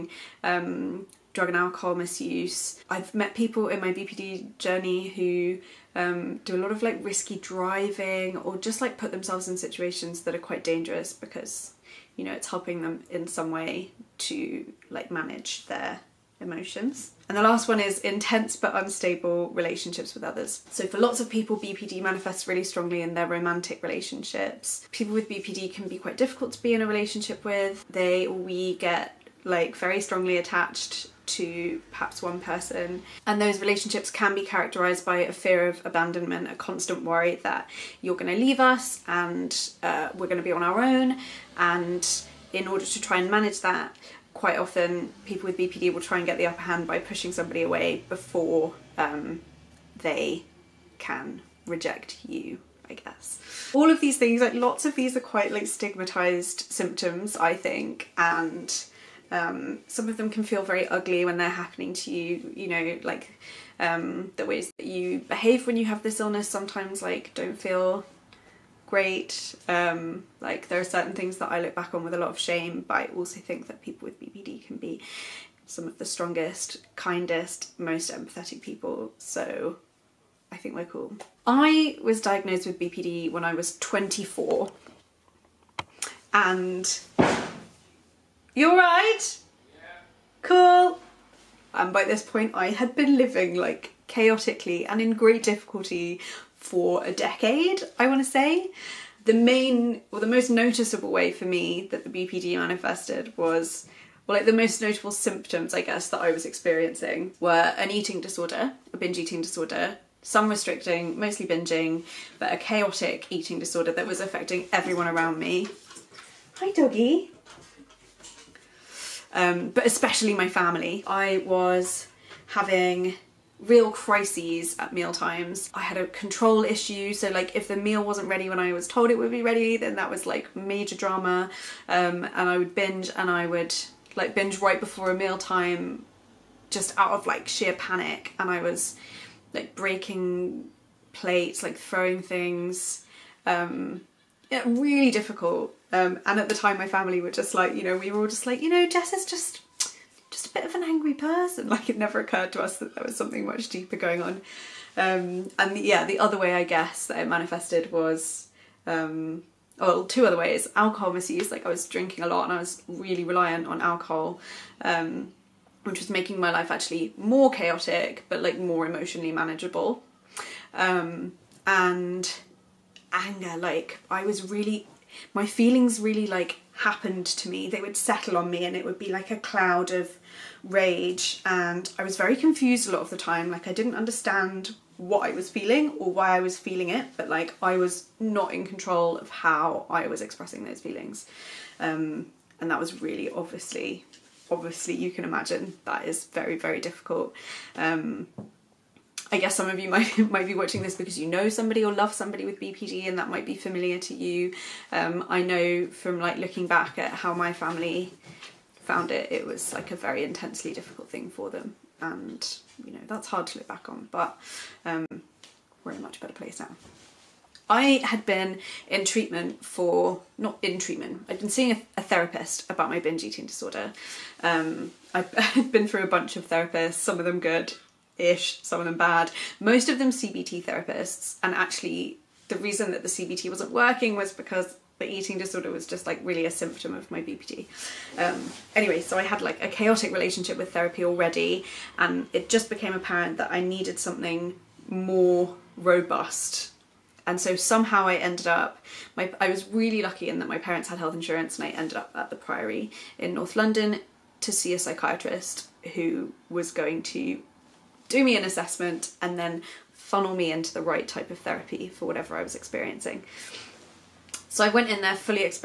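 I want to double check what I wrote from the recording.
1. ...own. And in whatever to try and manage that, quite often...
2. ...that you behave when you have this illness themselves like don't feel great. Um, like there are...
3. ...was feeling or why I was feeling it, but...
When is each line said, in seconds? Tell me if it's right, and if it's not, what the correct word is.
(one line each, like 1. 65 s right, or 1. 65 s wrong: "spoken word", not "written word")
1. 40 s wrong: "order", not "whatever"
2. 64 s wrong: "sometimes", not "themselves"
3. 185 s right.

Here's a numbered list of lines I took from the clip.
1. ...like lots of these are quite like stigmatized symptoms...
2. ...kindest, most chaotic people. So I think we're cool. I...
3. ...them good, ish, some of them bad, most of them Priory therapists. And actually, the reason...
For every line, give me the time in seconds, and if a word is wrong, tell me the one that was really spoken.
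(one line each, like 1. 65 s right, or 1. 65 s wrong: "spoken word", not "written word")
1. 54 s right
2. 76 s wrong: "empathetic", not "chaotic"
3. 227 s wrong: "CBT", not "Priory".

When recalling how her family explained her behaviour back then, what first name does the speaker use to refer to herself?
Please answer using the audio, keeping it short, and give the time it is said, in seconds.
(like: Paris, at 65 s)
Jess, at 148 s.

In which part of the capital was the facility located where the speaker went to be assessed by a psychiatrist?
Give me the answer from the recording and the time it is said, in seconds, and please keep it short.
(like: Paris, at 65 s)
North London, at 253 s.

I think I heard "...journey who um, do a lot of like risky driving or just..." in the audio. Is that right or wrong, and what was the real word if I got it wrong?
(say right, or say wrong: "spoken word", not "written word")
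right.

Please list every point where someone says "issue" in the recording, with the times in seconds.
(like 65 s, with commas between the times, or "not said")
126 s.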